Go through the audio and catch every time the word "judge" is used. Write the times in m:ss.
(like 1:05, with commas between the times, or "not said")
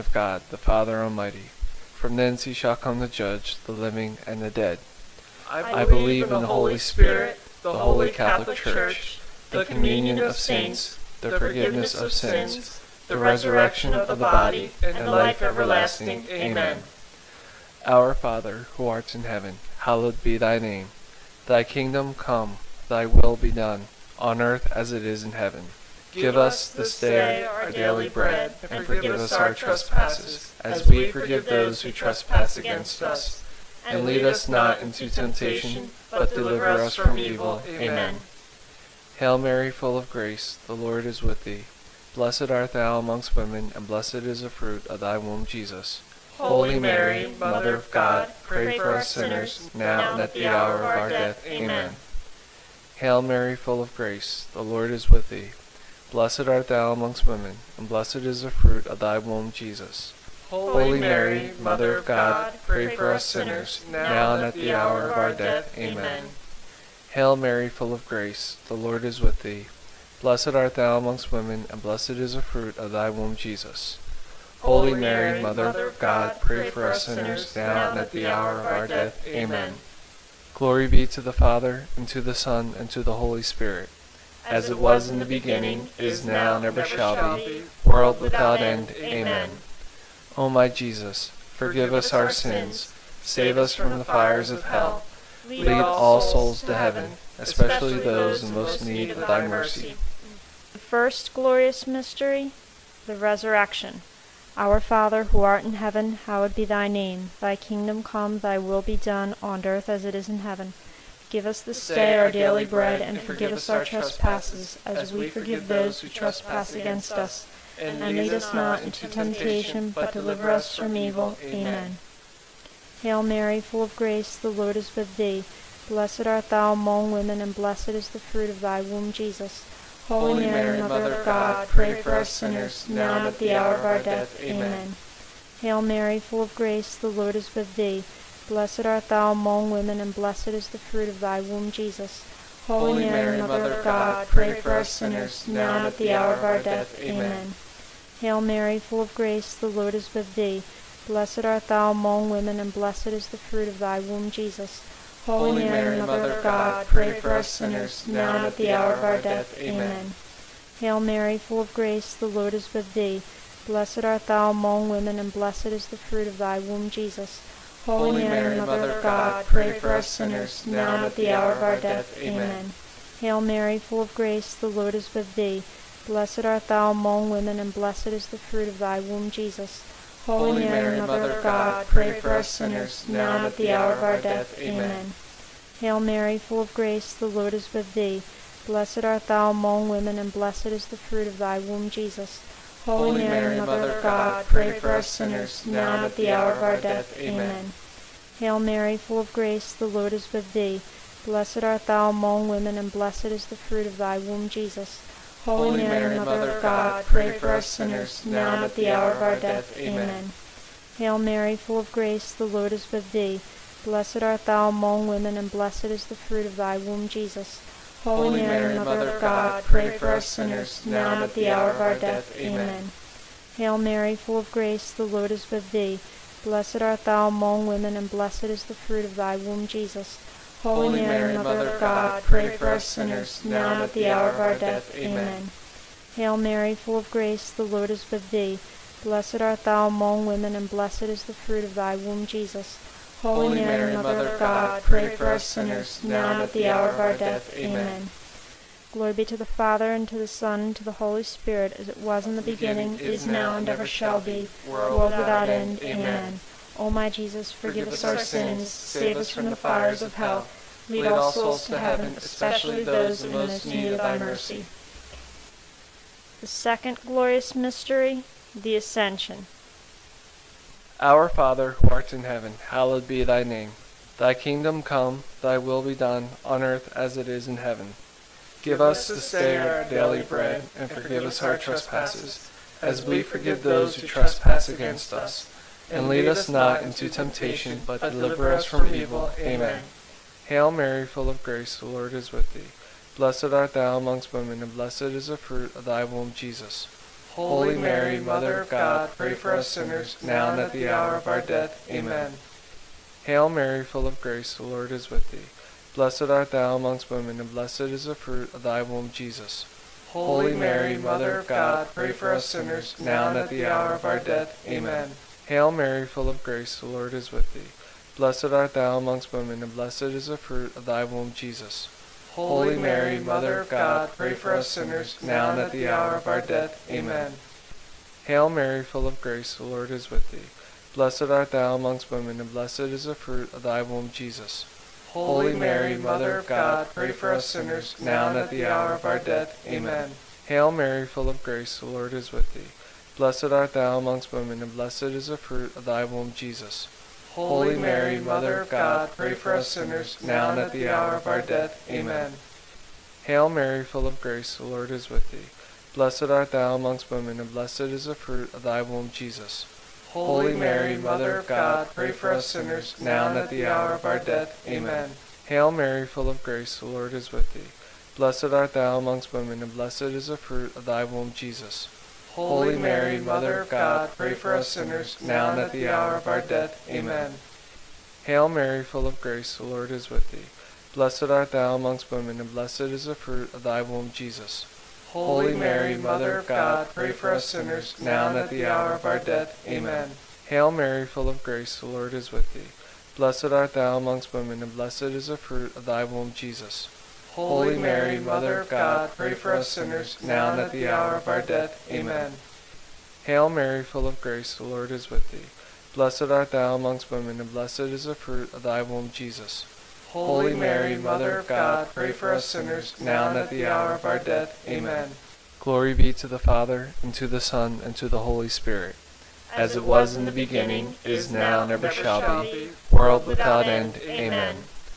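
0:03.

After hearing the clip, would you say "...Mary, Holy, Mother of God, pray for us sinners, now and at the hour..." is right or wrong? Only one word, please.
wrong.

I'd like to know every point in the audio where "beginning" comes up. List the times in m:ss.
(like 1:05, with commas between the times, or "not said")
1:25, 4:12, 7:00.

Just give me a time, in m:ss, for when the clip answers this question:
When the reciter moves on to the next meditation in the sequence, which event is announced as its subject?
4:28.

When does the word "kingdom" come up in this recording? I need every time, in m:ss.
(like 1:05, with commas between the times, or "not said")
0:21, 1:47, 4:34.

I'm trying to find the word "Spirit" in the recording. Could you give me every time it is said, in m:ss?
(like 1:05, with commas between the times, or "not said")
0:06, 1:23, 4:11, 6:58.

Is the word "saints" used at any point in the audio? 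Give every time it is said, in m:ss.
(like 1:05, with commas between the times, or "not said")
0:10.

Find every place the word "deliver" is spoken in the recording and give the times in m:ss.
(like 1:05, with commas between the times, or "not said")
0:36, 2:00, 4:48.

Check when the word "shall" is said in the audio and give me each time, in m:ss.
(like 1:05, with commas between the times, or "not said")
0:02, 1:26, 4:13, 7:01.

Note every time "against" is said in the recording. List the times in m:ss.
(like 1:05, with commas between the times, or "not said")
0:32, 1:56, 4:44.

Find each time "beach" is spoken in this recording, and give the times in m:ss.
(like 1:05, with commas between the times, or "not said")
not said.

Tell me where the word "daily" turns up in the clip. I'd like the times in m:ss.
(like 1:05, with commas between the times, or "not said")
0:27, 1:52, 4:39.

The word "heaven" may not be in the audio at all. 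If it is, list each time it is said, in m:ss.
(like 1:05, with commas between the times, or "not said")
0:19, 0:25, 1:36, 1:45, 1:50, 4:21, 4:32, 4:37.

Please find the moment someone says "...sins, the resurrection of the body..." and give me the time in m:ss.
0:12.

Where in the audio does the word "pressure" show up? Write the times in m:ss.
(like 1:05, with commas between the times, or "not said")
not said.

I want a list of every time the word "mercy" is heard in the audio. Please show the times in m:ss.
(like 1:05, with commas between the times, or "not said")
1:39, 4:24.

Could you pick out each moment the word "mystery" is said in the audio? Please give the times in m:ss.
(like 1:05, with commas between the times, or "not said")
1:41, 4:27.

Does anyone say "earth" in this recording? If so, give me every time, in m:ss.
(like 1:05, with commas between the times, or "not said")
0:24, 1:49, 4:36.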